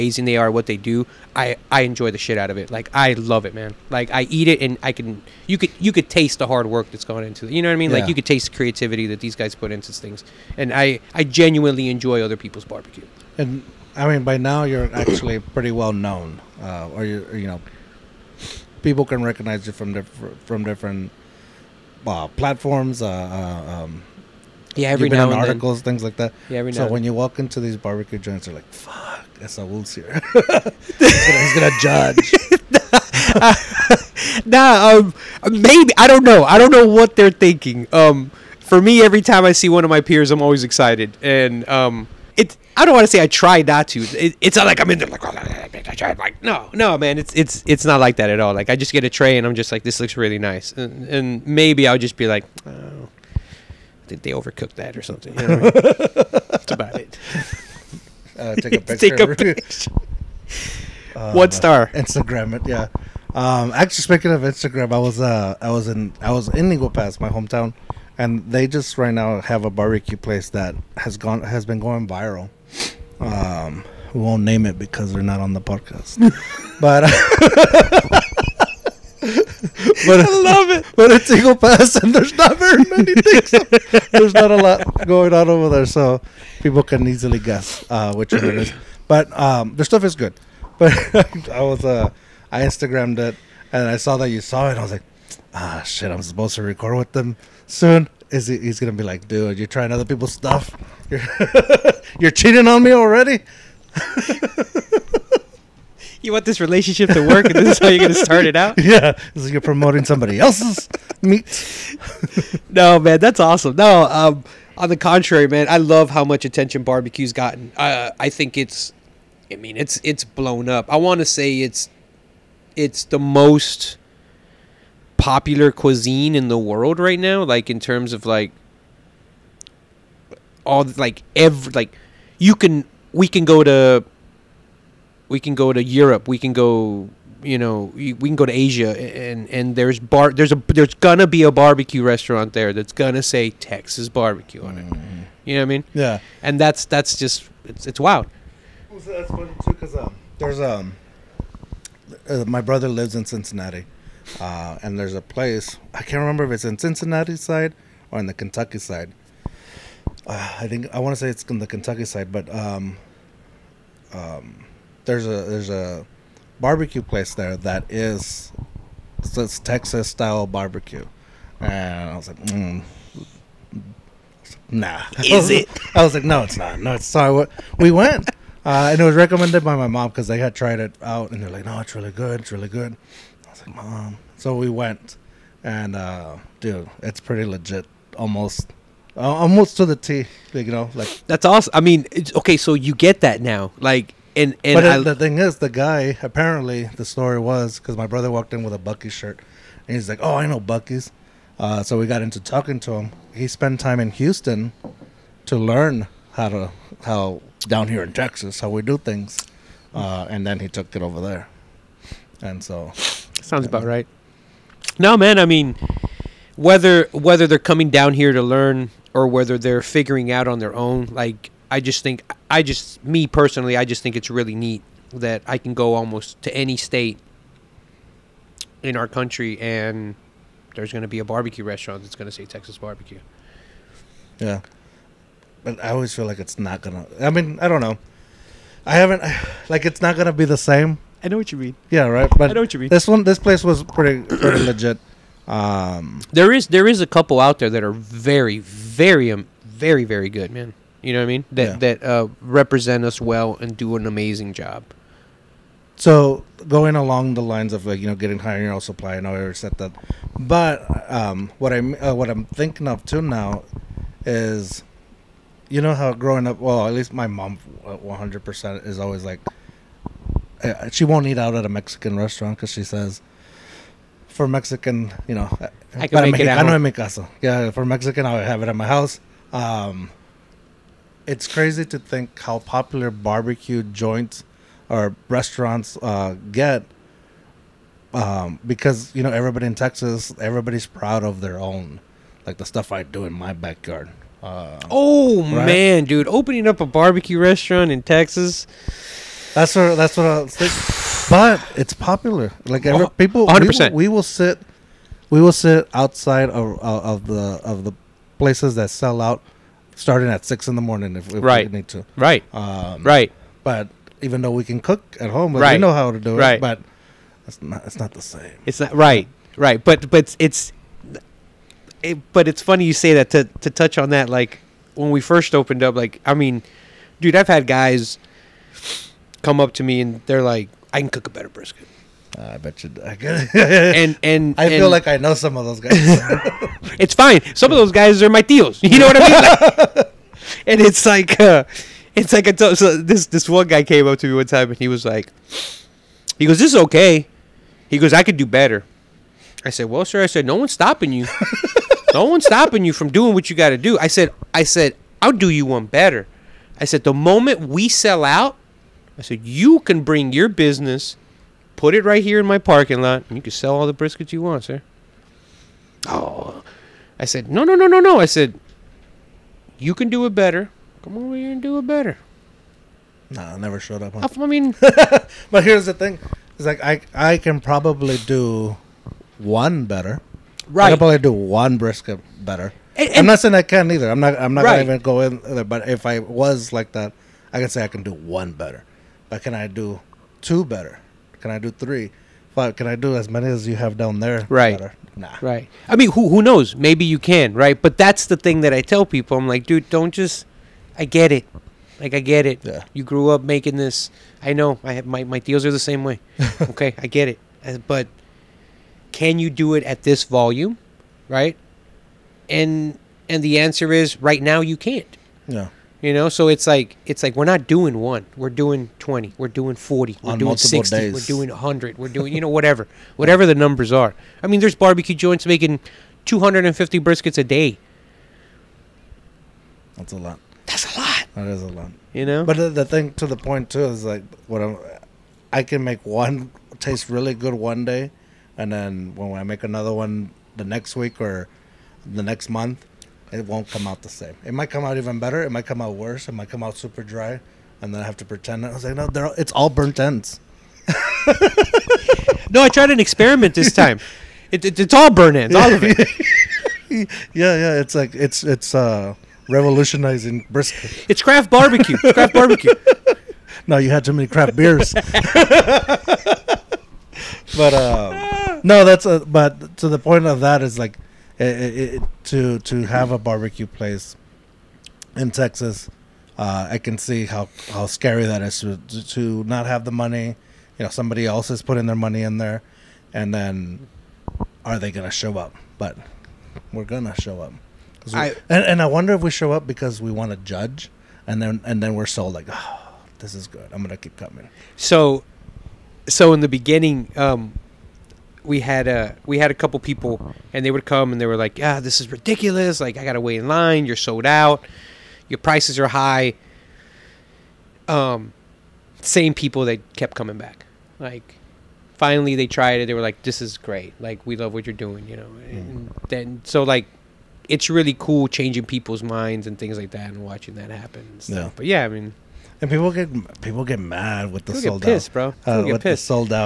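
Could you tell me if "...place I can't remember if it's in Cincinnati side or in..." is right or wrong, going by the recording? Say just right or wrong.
right.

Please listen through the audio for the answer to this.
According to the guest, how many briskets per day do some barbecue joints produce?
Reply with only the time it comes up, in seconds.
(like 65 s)
426 s.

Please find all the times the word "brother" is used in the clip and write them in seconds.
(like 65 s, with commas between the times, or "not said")
152 s, 198 s.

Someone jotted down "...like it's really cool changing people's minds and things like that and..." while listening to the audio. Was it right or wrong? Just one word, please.
right.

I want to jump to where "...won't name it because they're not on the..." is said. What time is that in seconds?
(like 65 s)
74 s.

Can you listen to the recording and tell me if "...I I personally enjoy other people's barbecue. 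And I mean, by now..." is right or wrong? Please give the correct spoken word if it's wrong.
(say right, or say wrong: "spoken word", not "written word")
wrong: "genuinely", not "personally".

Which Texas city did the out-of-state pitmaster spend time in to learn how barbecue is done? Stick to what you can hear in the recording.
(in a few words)
Houston.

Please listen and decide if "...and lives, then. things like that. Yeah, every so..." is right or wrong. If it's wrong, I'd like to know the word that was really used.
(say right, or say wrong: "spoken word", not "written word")
wrong: "articles", not "lives".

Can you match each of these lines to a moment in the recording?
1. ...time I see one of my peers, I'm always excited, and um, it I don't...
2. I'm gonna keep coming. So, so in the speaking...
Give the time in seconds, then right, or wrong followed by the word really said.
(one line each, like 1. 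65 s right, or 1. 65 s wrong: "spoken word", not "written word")
1. 39 s right
2. 493 s wrong: "beginning", not "speaking".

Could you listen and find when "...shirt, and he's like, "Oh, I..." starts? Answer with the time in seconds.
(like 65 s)
199 s.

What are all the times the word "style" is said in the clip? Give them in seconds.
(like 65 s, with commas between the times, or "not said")
170 s.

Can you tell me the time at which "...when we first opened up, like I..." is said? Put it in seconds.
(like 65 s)
324 s.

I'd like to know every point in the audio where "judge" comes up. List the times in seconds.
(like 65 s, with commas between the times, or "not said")
31 s, 490 s.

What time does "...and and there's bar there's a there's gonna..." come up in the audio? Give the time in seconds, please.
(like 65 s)
138 s.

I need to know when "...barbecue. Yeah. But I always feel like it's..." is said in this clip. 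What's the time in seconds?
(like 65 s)
232 s.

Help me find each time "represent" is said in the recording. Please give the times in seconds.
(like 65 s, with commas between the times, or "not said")
252 s.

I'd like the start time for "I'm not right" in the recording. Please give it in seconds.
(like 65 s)
384 s.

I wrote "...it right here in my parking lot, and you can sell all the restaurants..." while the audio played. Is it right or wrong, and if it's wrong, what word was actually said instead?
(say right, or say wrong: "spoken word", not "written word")
wrong: "briskets", not "restaurants".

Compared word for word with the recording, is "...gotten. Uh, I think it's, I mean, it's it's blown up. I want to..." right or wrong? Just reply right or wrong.
right.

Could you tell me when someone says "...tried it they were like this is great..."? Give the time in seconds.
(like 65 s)
512 s.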